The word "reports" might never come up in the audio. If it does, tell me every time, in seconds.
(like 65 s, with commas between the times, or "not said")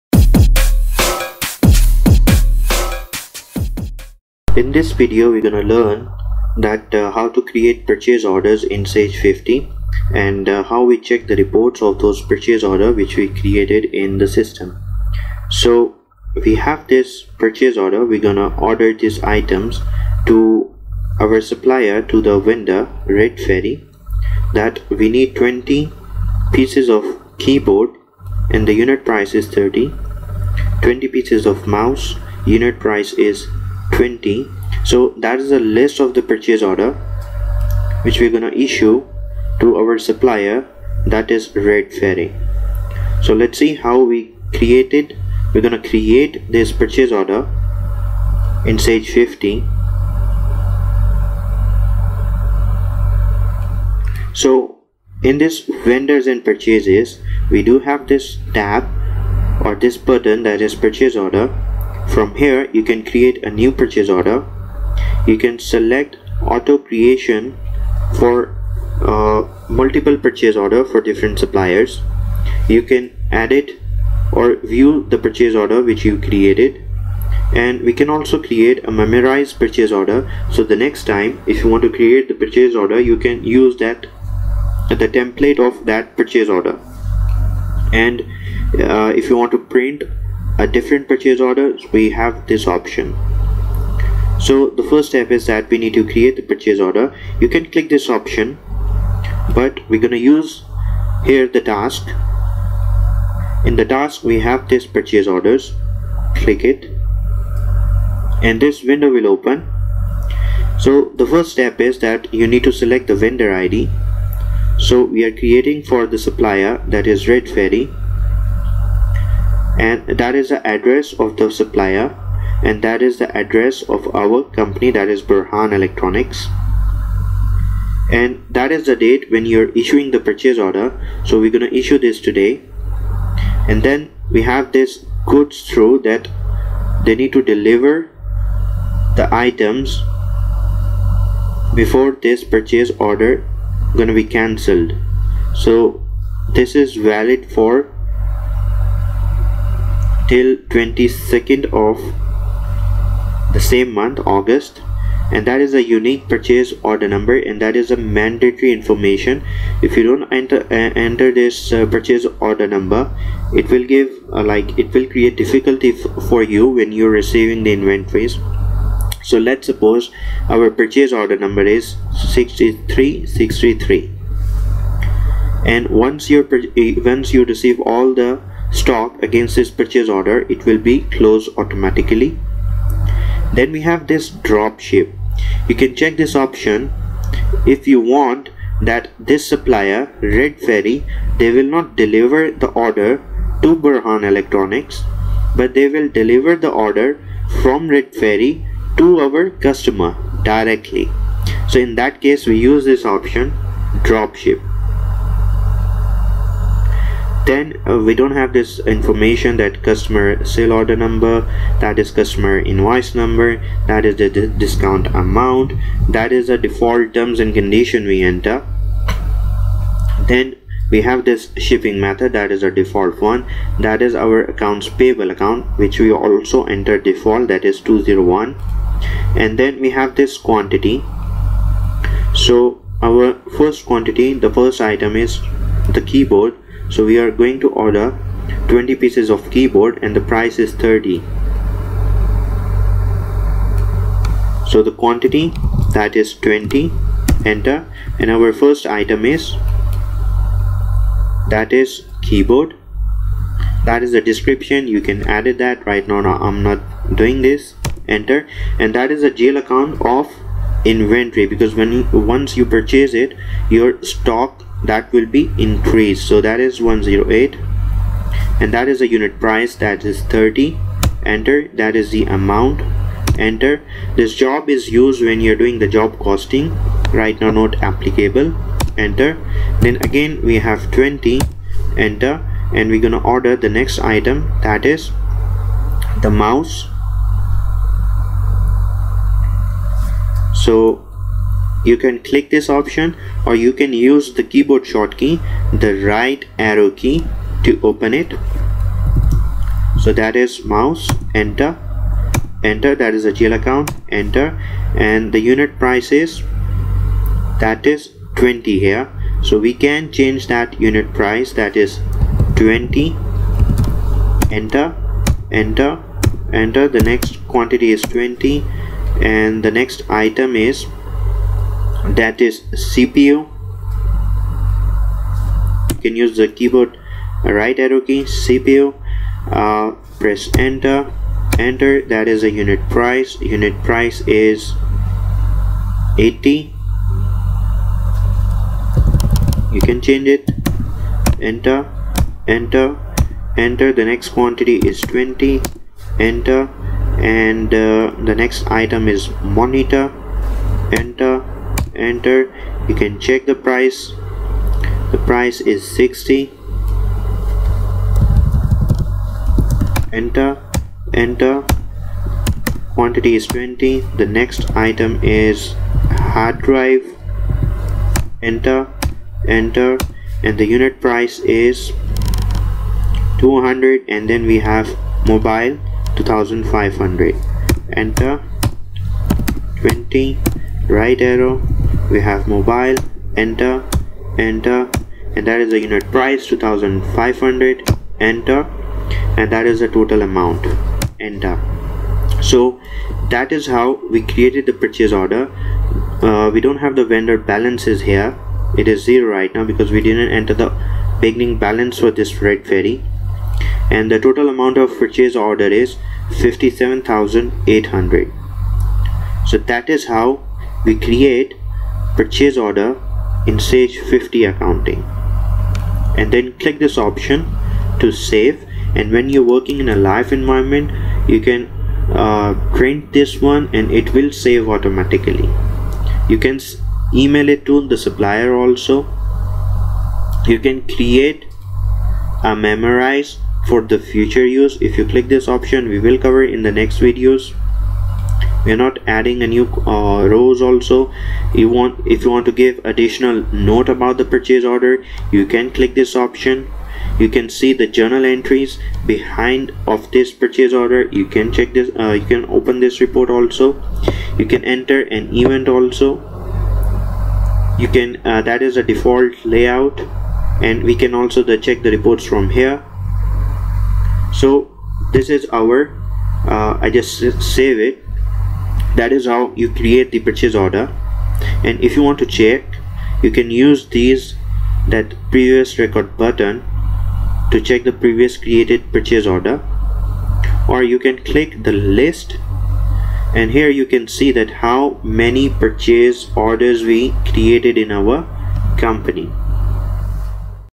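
11 s, 453 s, 461 s.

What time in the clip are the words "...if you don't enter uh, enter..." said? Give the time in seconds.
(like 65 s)
159 s.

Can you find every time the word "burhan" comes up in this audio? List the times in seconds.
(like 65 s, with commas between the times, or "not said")
125 s, 193 s.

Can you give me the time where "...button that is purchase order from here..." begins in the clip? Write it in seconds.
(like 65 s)
59 s.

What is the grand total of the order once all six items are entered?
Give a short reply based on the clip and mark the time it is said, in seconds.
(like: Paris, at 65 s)
57800, at 406 s.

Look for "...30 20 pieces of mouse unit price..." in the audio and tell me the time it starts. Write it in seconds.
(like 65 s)
29 s.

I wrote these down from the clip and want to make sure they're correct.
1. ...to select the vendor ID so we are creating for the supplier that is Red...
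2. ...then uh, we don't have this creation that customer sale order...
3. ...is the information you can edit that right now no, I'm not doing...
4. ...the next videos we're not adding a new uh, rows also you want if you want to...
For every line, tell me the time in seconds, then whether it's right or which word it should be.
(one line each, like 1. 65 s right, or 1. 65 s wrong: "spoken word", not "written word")
1. 112 s right
2. 207 s wrong: "information", not "creation"
3. 254 s wrong: "description", not "information"
4. 436 s right.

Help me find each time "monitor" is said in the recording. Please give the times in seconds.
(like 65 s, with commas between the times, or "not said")
349 s.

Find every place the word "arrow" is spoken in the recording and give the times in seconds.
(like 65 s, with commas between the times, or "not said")
296 s, 327 s, 381 s.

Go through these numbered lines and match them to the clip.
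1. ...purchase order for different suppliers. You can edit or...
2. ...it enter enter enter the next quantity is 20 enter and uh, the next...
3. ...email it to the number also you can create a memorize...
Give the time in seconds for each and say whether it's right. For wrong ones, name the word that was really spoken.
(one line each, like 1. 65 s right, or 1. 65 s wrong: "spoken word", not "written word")
1. 70 s right
2. 340 s right
3. 427 s wrong: "supplier", not "number".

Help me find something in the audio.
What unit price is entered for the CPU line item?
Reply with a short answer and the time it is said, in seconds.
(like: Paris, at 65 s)
80, at 336 s.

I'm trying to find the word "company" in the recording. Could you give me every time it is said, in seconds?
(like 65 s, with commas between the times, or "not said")
124 s, 488 s.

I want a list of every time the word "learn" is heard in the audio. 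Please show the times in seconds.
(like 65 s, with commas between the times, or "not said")
5 s.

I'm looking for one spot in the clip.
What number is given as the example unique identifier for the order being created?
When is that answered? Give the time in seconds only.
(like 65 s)
172 s.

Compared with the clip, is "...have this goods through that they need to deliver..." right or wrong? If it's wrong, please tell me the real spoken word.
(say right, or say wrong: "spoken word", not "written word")
right.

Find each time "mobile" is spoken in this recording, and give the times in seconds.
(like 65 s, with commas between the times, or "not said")
375 s, 382 s.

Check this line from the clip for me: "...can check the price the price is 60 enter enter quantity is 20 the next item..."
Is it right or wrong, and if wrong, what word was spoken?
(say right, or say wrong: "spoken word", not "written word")
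right.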